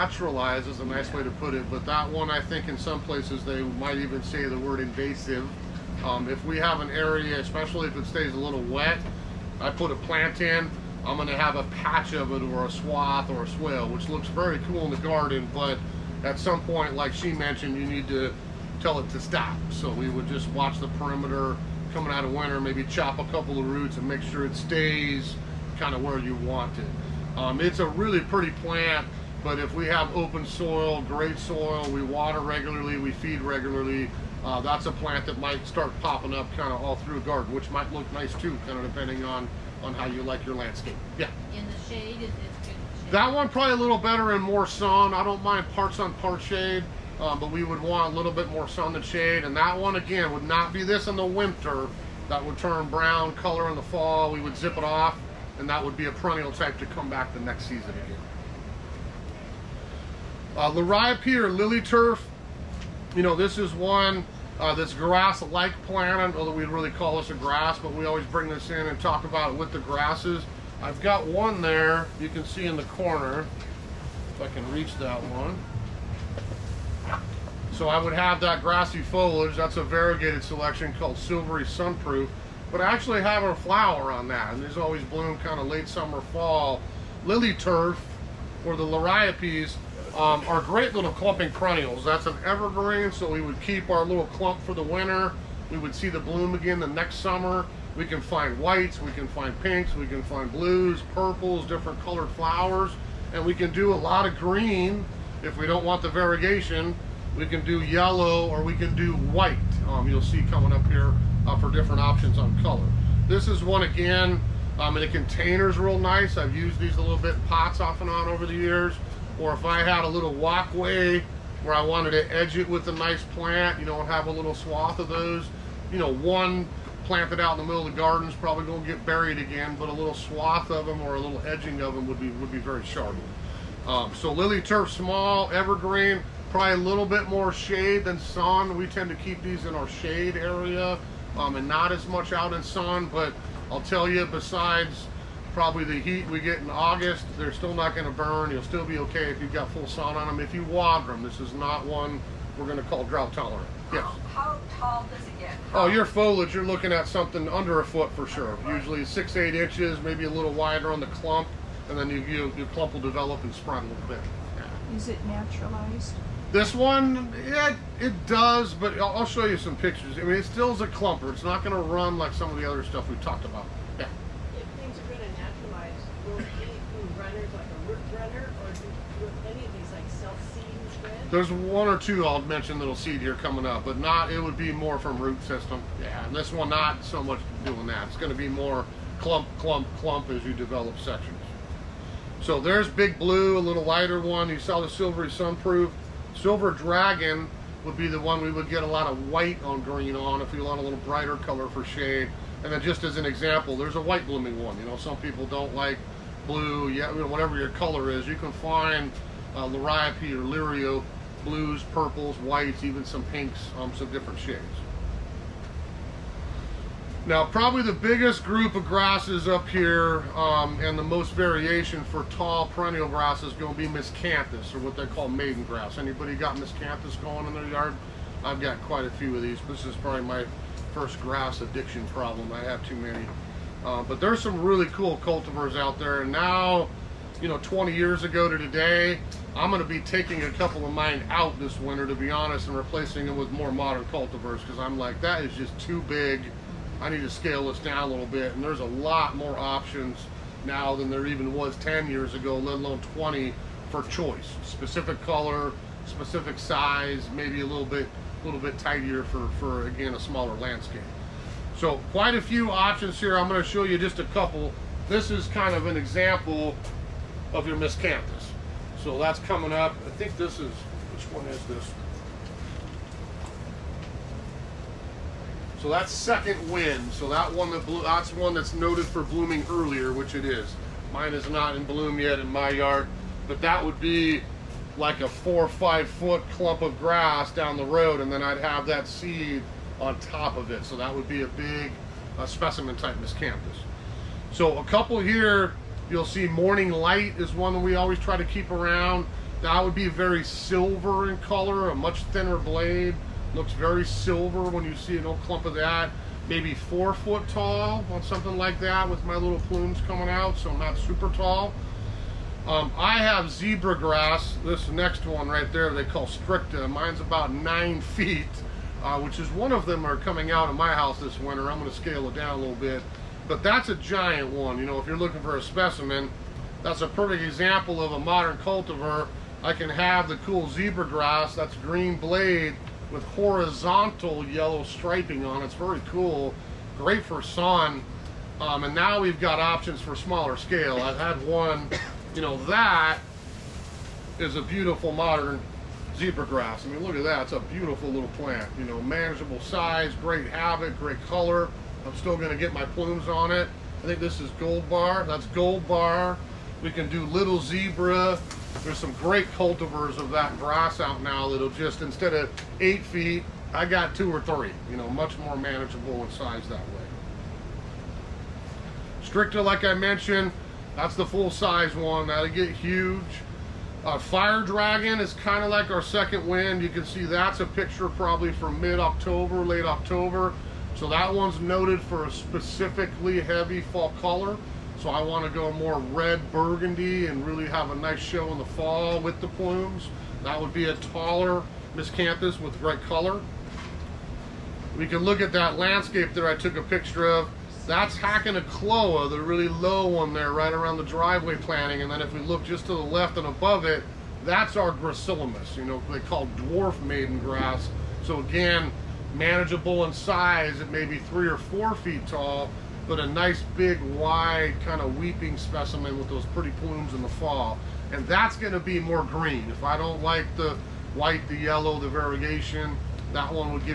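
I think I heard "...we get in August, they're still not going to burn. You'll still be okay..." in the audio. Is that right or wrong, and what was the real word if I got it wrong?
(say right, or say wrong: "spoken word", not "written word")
right.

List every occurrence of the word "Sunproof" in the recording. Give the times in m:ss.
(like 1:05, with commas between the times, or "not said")
1:21, 3:15.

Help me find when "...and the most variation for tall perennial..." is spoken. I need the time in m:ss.
3:40.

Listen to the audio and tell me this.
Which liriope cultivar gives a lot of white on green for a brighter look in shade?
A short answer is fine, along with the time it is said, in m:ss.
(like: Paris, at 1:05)
Silver Dragon, at 3:16.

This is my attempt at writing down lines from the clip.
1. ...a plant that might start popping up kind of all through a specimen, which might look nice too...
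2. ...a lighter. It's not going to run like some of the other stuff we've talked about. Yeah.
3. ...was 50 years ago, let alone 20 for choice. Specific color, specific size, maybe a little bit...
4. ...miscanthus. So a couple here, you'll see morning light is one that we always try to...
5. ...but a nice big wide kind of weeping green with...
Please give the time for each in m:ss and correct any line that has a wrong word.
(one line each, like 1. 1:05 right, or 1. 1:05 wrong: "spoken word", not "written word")
1. 0:34 wrong: "garden", not "specimen"
2. 2:50 wrong: "clumper", not "lighter"
3. 4:11 wrong: "10", not "50"
4. 4:53 right
5. 6:53 wrong: "specimen", not "green".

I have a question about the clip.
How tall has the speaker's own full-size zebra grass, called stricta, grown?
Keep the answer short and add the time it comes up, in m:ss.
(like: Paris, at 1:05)
9 feet, at 5:17.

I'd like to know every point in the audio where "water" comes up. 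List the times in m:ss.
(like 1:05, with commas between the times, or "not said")
0:32, 2:30.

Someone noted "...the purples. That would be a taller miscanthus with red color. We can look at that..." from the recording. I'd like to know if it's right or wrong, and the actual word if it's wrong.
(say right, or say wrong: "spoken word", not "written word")
wrong: "plumes", not "purples".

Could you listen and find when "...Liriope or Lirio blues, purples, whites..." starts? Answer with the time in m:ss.
3:29.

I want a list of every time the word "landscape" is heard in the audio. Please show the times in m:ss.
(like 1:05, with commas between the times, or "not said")
0:40, 4:20, 6:35.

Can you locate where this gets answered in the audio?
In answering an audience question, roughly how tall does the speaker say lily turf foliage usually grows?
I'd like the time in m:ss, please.
2:39.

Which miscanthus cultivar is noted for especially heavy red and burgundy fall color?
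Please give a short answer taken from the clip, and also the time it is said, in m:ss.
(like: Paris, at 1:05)
Fire Dragon, at 6:14.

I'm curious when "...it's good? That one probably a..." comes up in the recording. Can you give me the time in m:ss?
0:42.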